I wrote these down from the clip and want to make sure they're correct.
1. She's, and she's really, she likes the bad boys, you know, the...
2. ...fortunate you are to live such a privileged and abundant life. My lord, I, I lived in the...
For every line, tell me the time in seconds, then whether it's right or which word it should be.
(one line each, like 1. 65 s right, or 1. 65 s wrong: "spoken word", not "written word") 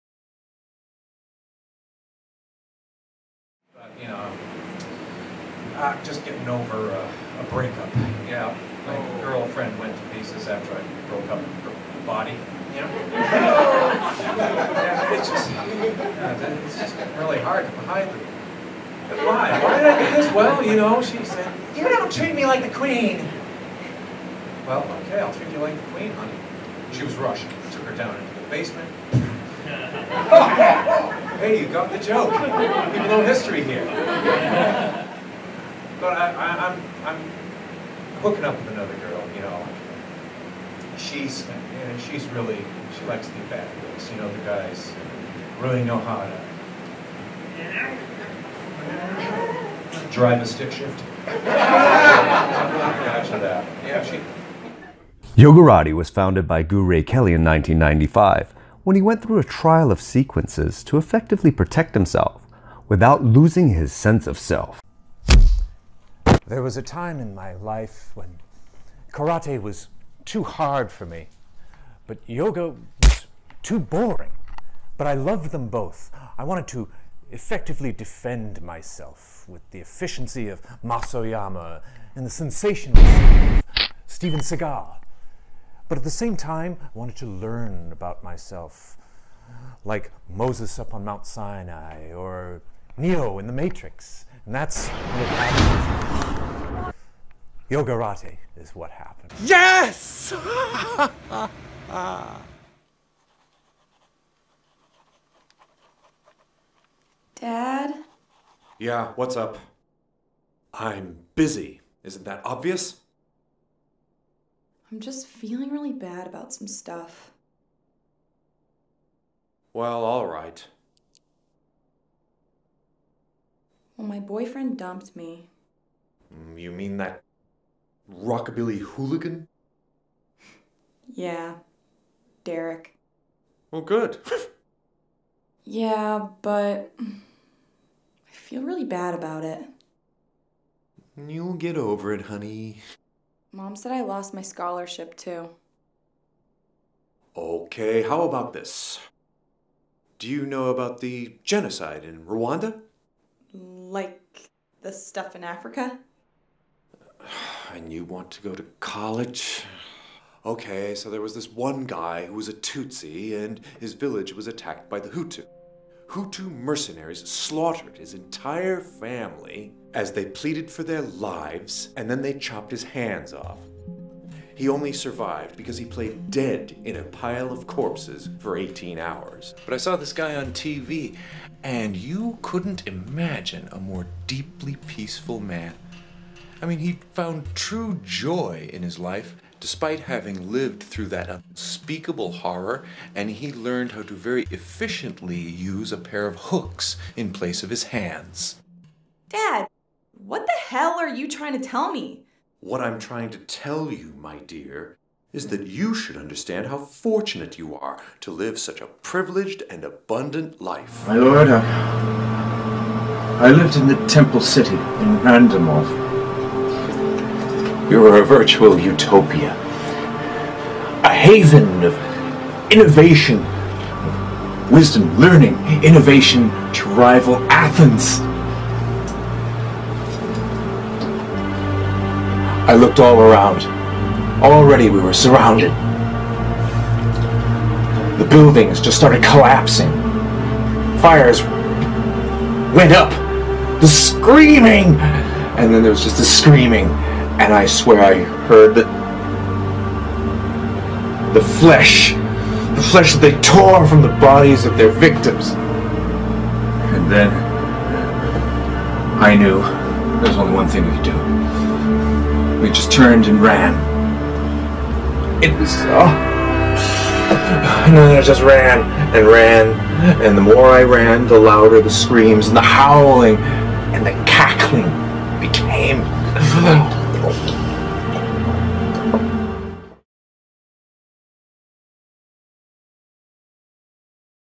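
1. 40 s right
2. 206 s right.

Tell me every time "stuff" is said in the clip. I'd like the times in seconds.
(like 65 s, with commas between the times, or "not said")
116 s, 154 s.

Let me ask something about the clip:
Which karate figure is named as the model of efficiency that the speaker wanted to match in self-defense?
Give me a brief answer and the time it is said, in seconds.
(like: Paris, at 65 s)
Mas Oyama, at 80 s.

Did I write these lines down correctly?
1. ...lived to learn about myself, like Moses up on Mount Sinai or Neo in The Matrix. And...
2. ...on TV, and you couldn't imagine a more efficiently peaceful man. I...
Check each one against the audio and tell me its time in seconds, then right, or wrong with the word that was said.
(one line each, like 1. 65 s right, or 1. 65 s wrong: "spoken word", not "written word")
1. 86 s wrong: "wanted", not "lived"
2. 180 s wrong: "deeply", not "efficiently".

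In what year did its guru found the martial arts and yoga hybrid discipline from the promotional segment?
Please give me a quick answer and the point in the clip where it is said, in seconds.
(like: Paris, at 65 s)
1995, at 57 s.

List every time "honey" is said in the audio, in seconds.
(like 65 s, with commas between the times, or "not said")
26 s, 142 s.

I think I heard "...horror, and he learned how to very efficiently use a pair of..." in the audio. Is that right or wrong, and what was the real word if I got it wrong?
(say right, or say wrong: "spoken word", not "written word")
right.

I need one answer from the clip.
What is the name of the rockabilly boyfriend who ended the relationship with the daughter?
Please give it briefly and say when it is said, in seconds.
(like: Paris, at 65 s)
Derek, at 132 s.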